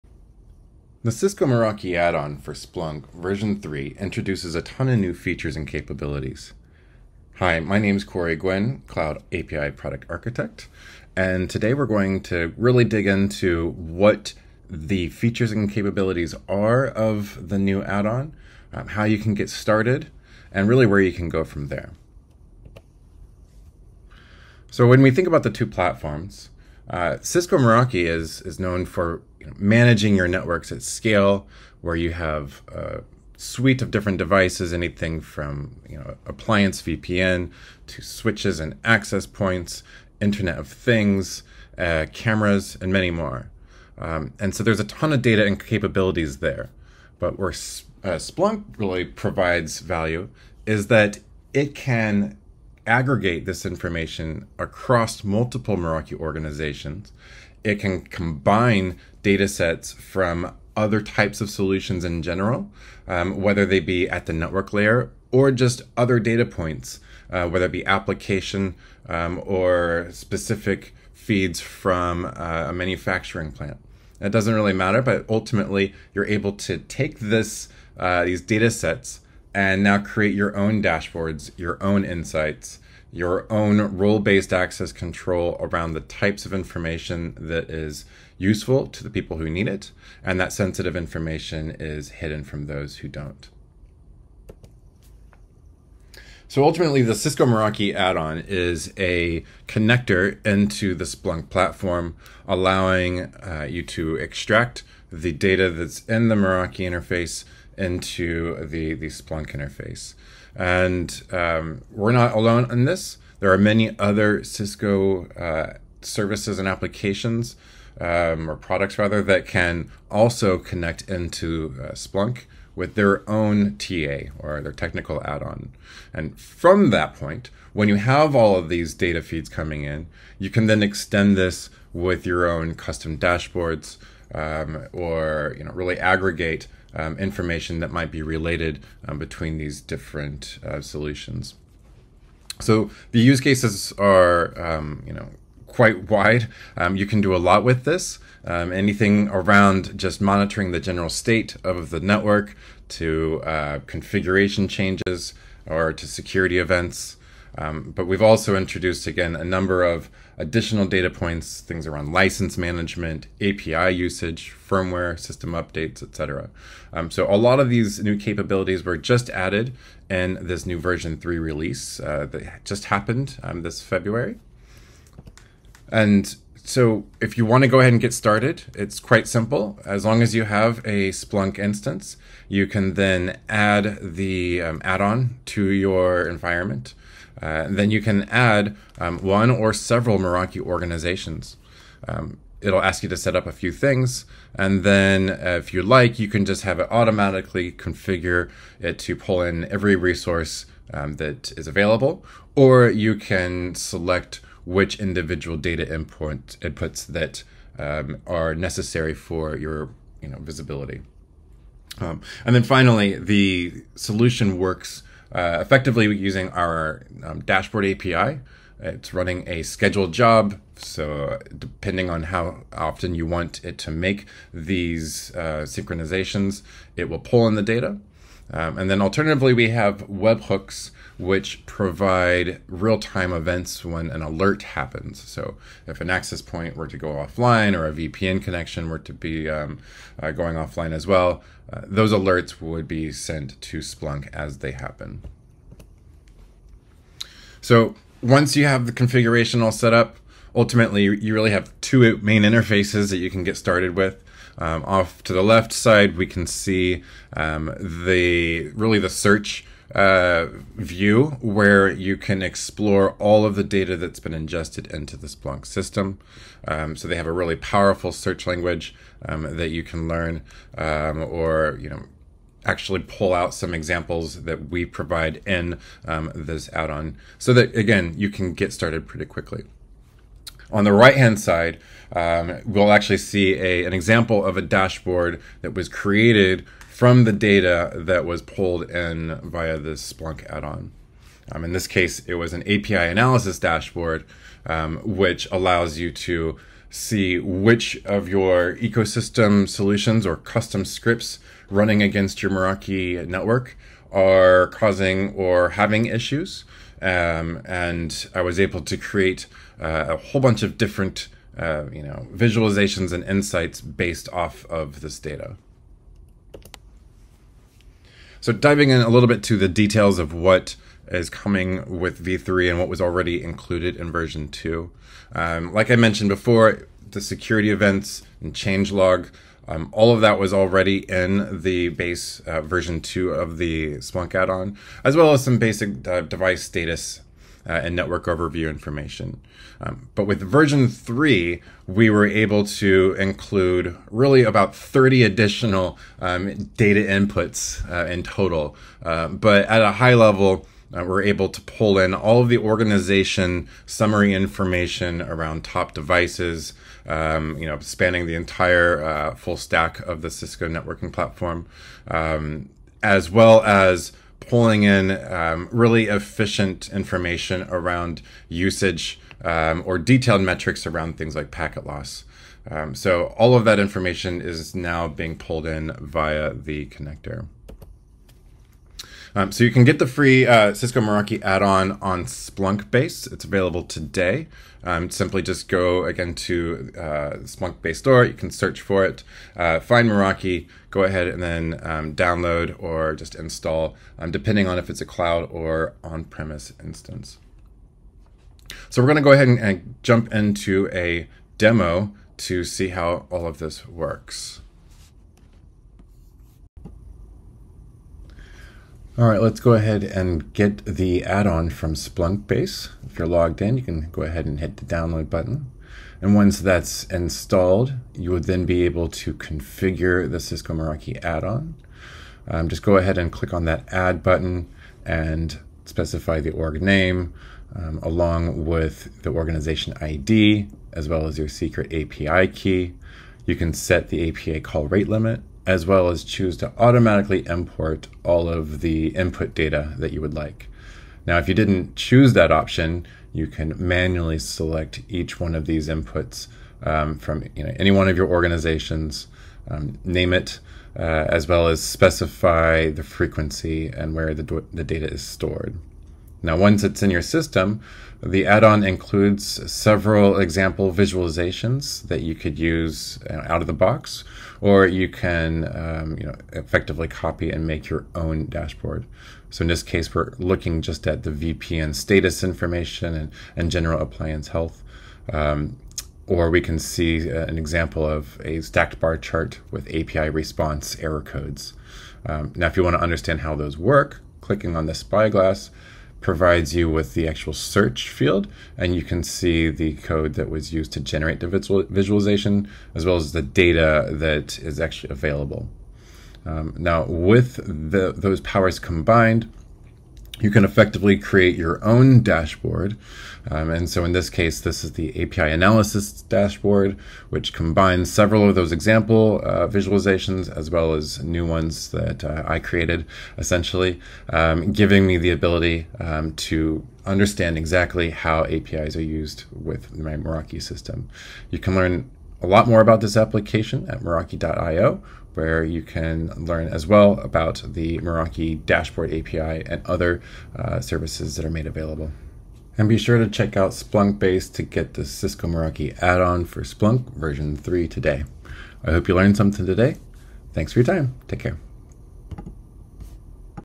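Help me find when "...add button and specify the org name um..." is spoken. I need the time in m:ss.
7:03.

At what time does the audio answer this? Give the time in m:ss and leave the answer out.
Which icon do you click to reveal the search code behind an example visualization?
8:04.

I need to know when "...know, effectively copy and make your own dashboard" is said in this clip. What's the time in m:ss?
7:46.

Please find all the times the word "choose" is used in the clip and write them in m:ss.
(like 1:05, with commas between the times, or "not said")
7:16, 7:21.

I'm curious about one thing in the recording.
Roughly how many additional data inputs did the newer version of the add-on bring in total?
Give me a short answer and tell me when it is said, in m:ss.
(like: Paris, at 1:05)
30, at 5:44.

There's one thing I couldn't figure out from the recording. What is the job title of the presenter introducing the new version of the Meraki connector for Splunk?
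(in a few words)
Cloud API Product Architect.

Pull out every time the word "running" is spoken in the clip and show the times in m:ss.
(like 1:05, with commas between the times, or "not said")
3:39, 5:01.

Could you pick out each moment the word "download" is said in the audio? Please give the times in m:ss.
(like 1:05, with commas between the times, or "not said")
6:32, 6:54.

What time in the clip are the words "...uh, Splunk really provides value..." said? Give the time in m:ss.
0:47.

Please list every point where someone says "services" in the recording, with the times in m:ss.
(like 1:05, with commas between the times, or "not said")
1:56, 8:50.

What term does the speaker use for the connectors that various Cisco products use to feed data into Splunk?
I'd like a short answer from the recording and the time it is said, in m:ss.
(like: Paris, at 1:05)
technical add on, at 2:04.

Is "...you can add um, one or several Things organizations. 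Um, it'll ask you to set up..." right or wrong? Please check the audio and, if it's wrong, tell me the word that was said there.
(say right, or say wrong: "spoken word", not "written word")
wrong: "Meraki", not "Things".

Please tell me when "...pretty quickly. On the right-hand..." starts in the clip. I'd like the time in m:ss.
4:39.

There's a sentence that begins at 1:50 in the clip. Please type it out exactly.
And um, we're not alone in this.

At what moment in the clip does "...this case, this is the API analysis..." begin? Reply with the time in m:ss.
8:24.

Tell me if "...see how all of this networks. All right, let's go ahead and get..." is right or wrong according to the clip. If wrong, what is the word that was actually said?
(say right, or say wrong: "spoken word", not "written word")
wrong: "works", not "networks".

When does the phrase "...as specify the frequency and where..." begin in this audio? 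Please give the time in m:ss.
7:31.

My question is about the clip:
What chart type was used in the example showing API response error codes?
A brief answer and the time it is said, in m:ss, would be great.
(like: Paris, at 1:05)
stacked bar chart, at 7:58.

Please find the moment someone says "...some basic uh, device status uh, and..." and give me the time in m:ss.
5:35.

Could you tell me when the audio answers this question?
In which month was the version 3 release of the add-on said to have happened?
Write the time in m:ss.
2:53.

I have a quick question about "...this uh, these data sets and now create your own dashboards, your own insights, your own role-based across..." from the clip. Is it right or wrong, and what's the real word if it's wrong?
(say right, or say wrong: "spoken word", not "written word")
wrong: "access", not "across".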